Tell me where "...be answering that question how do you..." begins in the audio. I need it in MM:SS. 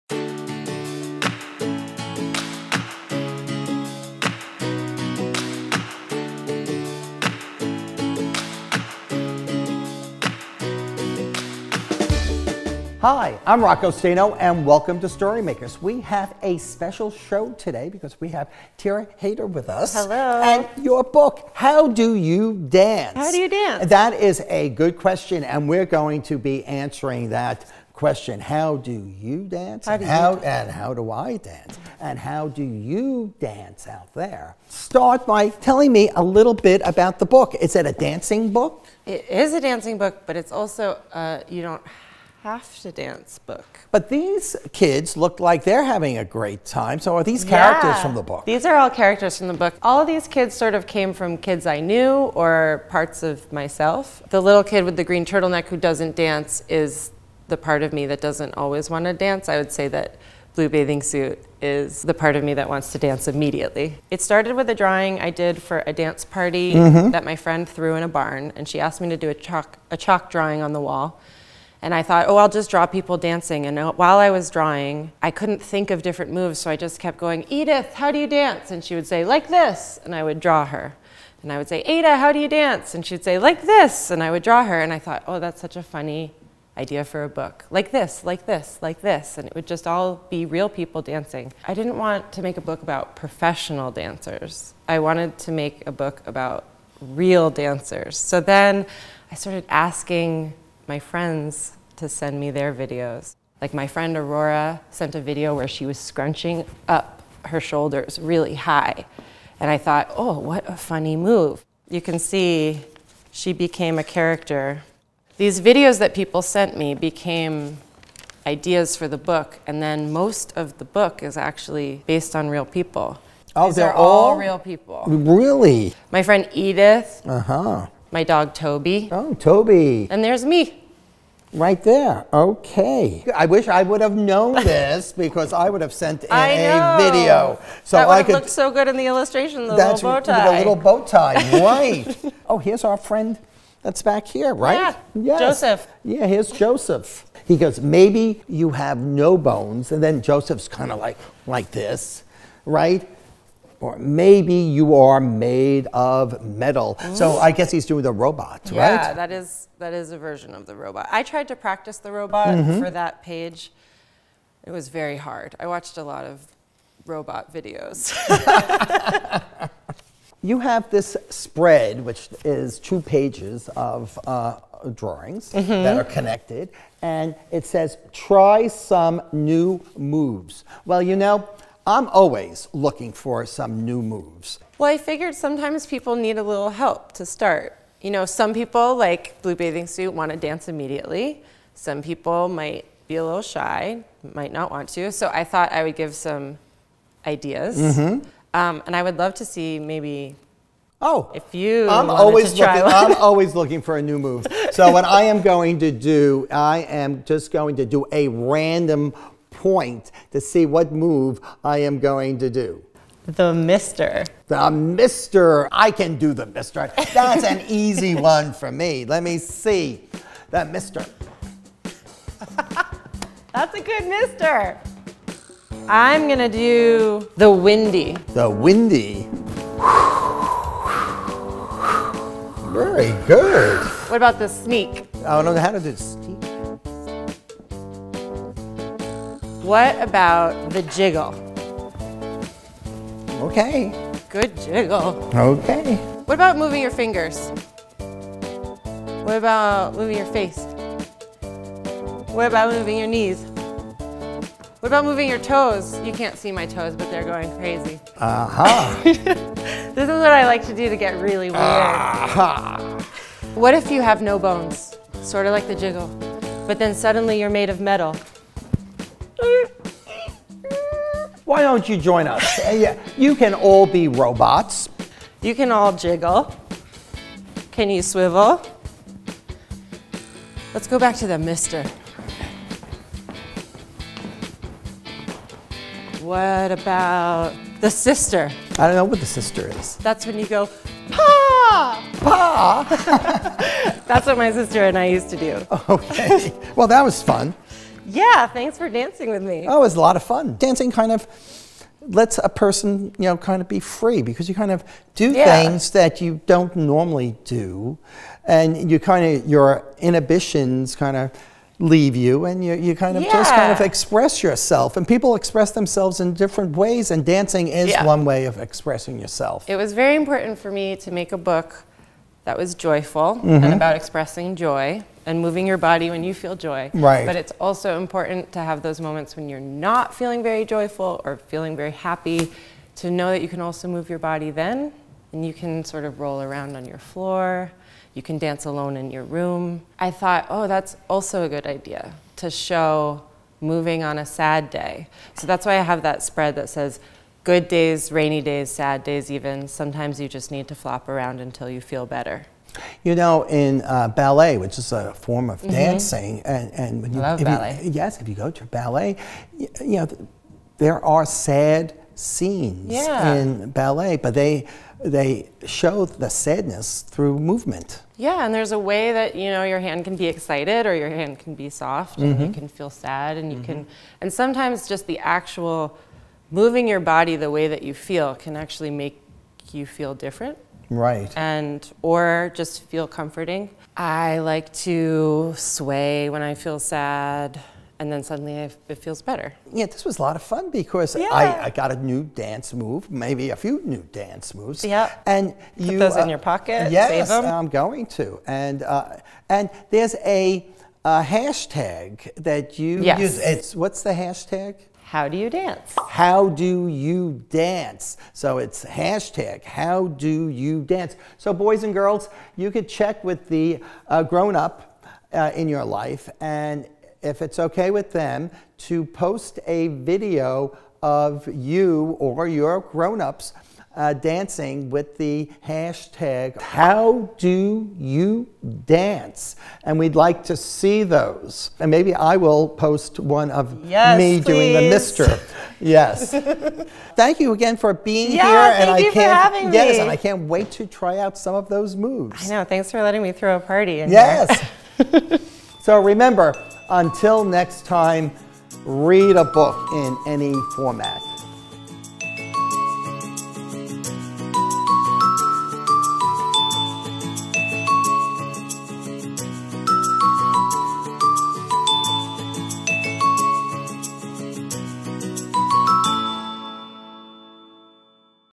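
00:26.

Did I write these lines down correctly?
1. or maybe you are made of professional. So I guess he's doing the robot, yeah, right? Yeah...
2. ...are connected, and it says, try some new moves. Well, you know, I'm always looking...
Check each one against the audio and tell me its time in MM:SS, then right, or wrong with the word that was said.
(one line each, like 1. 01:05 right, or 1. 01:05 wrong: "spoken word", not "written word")
1. 02:33 wrong: "metal", not "professional"
2. 02:55 right.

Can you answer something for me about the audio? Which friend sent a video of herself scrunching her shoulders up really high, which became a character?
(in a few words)
Aurora.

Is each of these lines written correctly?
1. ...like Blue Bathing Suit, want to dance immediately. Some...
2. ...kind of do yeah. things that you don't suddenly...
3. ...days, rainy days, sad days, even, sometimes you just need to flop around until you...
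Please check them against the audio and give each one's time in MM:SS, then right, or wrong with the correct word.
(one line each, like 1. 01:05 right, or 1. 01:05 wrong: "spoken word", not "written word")
1. 03:08 right
2. 05:04 wrong: "normally", not "suddenly"
3. 05:47 right.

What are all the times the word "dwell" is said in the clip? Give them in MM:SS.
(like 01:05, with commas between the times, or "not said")
not said.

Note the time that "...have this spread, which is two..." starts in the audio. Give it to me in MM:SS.
02:50.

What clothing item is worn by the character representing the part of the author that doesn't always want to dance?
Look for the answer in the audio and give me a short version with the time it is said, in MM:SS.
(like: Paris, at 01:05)
Green turtleneck, at 00:55.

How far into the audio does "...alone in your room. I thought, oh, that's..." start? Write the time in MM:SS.
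05:38.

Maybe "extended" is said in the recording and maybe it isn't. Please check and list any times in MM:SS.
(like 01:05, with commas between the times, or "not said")
not said.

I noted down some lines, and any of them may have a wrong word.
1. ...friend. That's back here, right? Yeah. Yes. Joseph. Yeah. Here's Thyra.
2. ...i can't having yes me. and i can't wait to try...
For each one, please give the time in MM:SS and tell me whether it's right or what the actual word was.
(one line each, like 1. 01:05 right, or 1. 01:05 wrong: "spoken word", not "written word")
1. 02:22 wrong: "Joseph", not "Thyra"
2. 07:19 right.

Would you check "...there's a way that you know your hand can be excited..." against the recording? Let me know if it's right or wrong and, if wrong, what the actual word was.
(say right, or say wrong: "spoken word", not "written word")
right.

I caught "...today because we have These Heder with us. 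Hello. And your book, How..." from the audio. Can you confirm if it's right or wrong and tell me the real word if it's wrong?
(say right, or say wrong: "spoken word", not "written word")
wrong: "Thyra", not "These".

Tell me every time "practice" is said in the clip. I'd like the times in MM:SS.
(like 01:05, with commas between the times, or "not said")
02:41.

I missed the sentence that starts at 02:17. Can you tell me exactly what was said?
So that would I could, looked so good in the illustration.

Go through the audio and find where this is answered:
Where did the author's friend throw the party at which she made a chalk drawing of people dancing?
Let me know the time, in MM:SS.
01:07.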